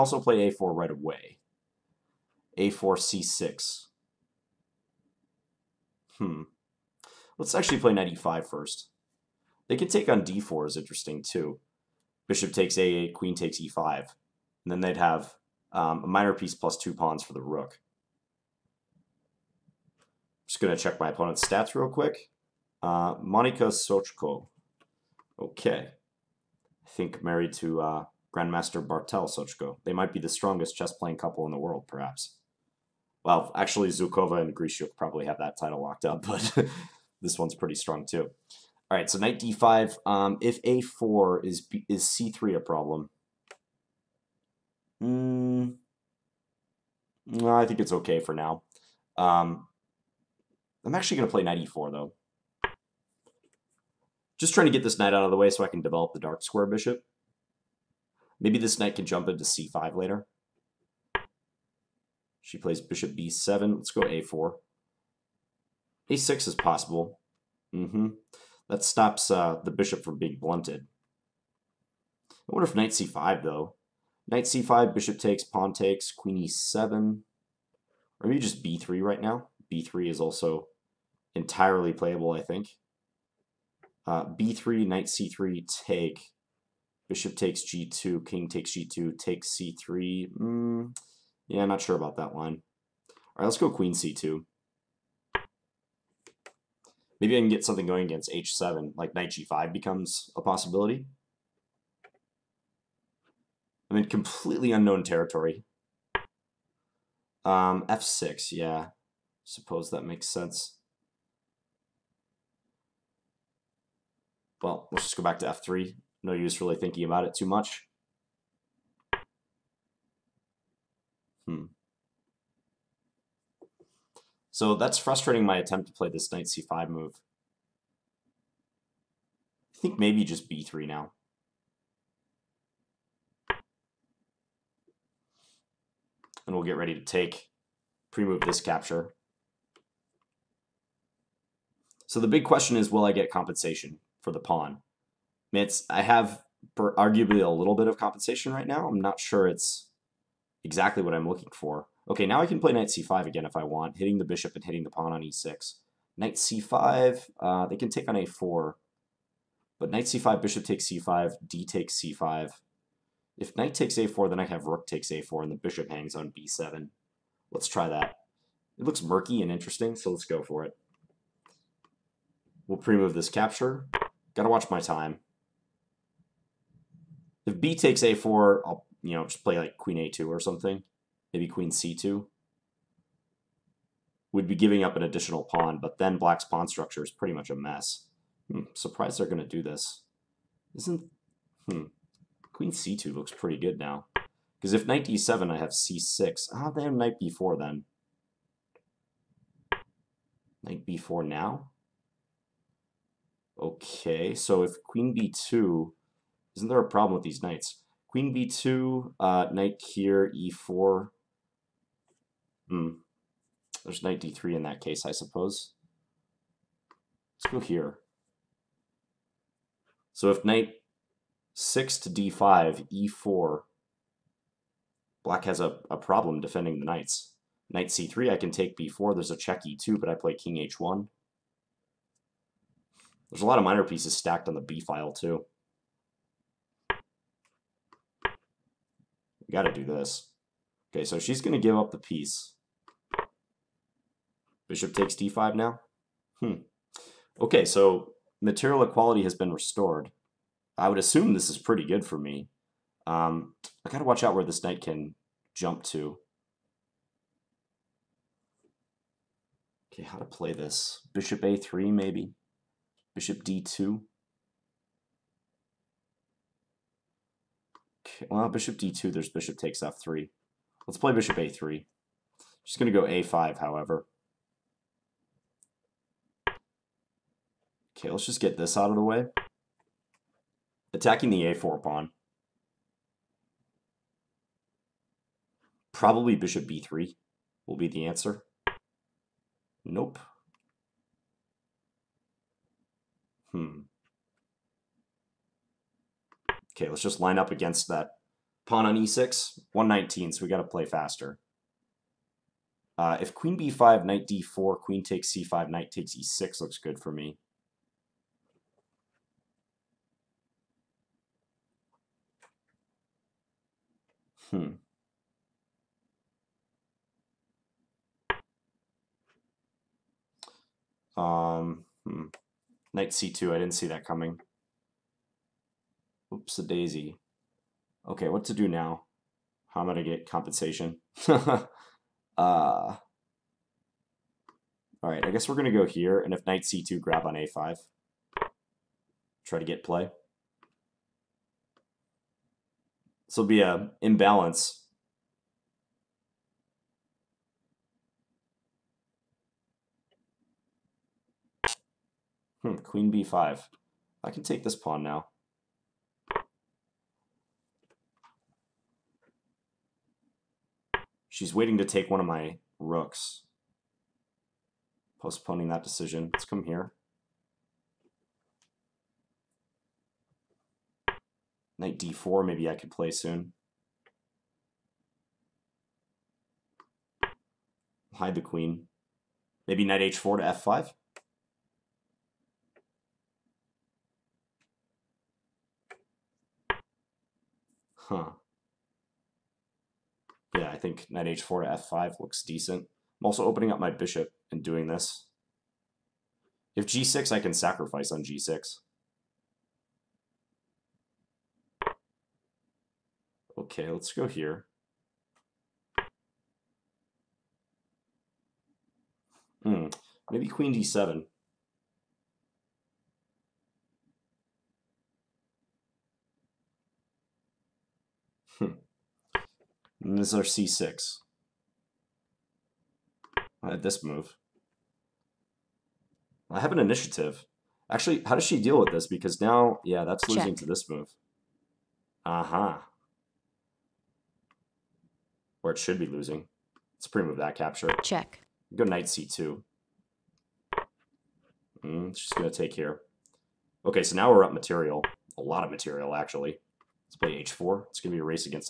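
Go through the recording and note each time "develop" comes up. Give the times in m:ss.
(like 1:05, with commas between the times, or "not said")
0:55.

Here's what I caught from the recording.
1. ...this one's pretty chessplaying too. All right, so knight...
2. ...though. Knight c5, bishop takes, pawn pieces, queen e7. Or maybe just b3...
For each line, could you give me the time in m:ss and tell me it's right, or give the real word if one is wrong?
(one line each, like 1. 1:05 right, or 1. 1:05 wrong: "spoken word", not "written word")
1. 0:37 wrong: "strong", not "chessplaying"
2. 1:13 wrong: "takes", not "pieces".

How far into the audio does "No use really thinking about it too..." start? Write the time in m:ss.
1:56.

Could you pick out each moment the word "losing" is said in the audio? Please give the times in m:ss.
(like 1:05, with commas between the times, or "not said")
7:10, 7:16.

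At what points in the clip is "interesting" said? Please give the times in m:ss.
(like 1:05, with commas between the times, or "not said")
0:10, 2:49.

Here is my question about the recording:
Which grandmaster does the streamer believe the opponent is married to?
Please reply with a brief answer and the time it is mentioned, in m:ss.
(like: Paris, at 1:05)
Bartosz Socko, at 0:28.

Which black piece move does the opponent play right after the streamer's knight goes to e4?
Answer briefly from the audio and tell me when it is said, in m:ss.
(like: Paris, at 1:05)
Bishop b7, at 1:02.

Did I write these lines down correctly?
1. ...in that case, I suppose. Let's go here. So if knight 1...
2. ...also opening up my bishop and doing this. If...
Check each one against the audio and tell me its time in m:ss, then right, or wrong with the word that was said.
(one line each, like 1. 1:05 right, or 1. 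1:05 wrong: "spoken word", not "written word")
1. 3:34 wrong: "6", not "1"
2. 6:33 right.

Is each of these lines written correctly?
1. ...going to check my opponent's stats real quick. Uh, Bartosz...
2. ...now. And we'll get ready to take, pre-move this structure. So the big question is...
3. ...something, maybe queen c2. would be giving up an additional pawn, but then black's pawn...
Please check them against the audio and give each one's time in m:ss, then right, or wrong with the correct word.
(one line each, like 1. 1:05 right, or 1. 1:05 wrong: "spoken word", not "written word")
1. 0:20 wrong: "Monika", not "Bartosz"
2. 2:10 wrong: "capture", not "structure"
3. 3:00 right.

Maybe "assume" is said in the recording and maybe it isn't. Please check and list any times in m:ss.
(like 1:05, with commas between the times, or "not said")
4:10.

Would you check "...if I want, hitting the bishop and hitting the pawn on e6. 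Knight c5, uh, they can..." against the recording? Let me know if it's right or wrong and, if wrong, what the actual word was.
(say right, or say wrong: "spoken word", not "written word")
right.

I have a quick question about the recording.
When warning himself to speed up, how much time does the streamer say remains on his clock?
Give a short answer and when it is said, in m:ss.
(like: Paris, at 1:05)
119, at 4:59.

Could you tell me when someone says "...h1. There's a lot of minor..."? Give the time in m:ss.
3:50.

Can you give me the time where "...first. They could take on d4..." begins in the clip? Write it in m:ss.
0:08.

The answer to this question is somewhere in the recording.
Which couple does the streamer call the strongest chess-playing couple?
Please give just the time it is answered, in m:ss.
0:33.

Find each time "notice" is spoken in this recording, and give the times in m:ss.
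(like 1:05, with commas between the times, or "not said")
not said.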